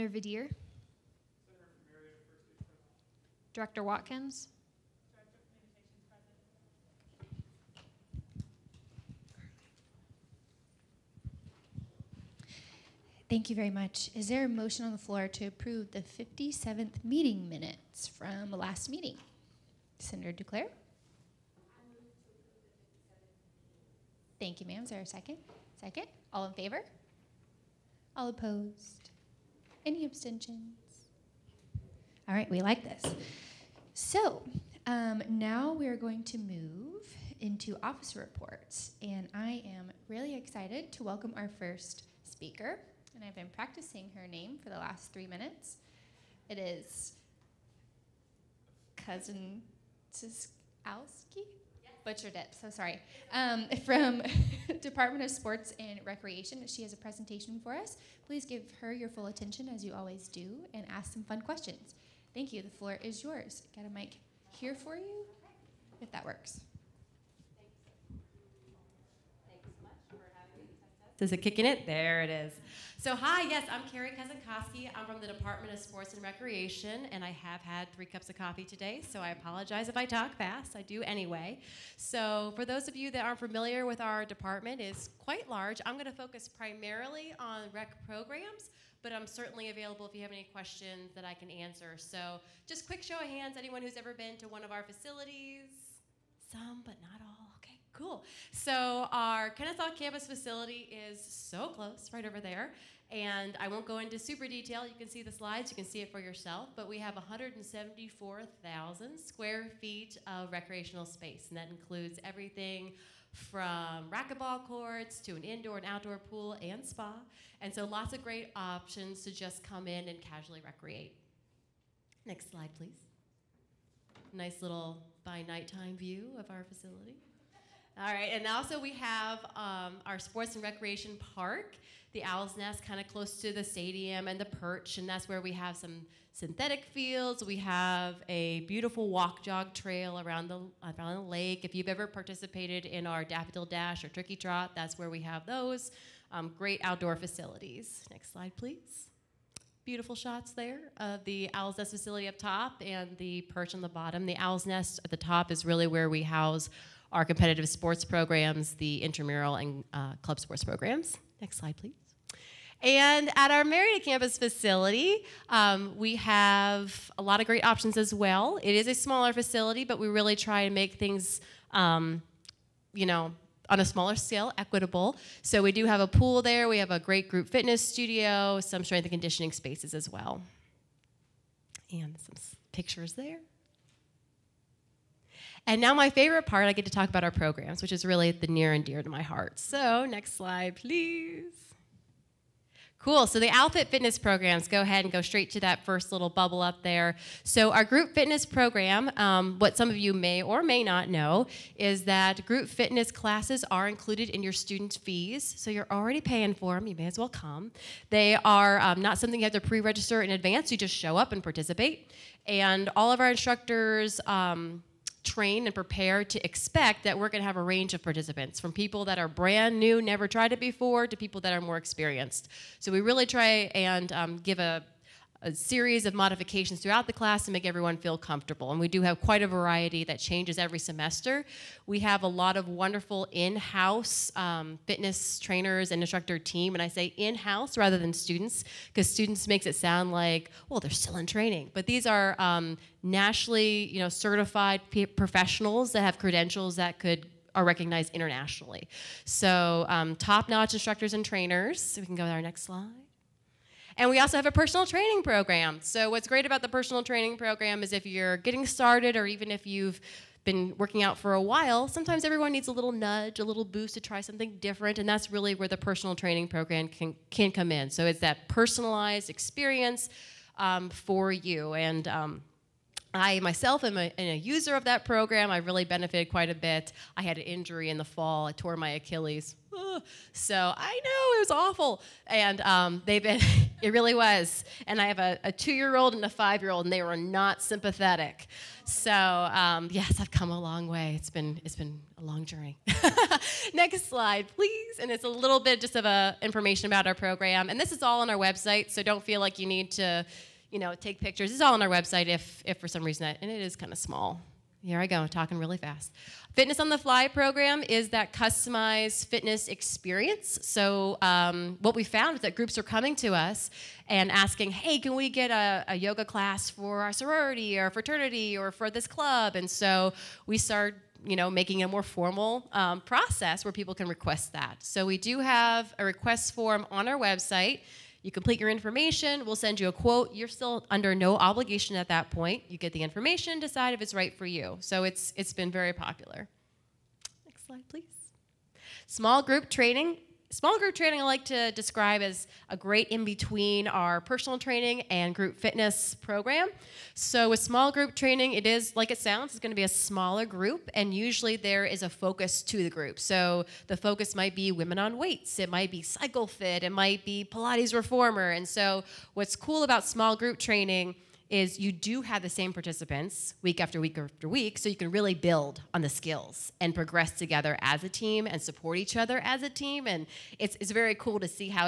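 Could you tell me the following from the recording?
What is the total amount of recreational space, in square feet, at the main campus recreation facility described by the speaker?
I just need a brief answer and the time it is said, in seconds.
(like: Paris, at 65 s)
174,000, at 107 s.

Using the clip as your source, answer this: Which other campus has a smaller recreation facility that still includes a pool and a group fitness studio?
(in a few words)
Marietta.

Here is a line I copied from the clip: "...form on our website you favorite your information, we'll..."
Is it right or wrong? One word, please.
wrong.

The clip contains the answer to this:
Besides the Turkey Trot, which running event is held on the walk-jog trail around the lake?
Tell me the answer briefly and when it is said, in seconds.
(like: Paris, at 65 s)
Daffodil Dash, at 143 s.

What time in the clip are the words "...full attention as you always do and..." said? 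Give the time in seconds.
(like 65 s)
59 s.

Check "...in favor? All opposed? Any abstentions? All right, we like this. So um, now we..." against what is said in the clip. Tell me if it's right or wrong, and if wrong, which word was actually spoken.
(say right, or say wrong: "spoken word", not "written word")
right.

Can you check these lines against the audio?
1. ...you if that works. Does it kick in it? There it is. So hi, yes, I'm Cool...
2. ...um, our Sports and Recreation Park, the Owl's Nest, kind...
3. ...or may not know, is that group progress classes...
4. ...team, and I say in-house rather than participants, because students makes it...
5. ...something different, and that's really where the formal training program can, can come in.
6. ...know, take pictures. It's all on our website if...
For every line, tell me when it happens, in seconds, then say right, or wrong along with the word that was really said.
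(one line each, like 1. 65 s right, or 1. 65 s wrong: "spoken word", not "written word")
1. 64 s wrong: "Carrie", not "Cool"
2. 129 s right
3. 200 s wrong: "fitness", not "progress"
4. 236 s wrong: "students", not "participants"
5. 264 s wrong: "personal", not "formal"
6. 300 s right.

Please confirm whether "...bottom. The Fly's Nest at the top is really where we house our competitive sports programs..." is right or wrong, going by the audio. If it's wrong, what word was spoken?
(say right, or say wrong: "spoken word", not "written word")
wrong: "Owl", not "Fly".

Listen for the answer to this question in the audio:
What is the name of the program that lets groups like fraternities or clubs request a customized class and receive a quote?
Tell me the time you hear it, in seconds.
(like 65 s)
306 s.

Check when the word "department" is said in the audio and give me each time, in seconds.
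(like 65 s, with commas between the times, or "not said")
54 s, 75 s, 84 s.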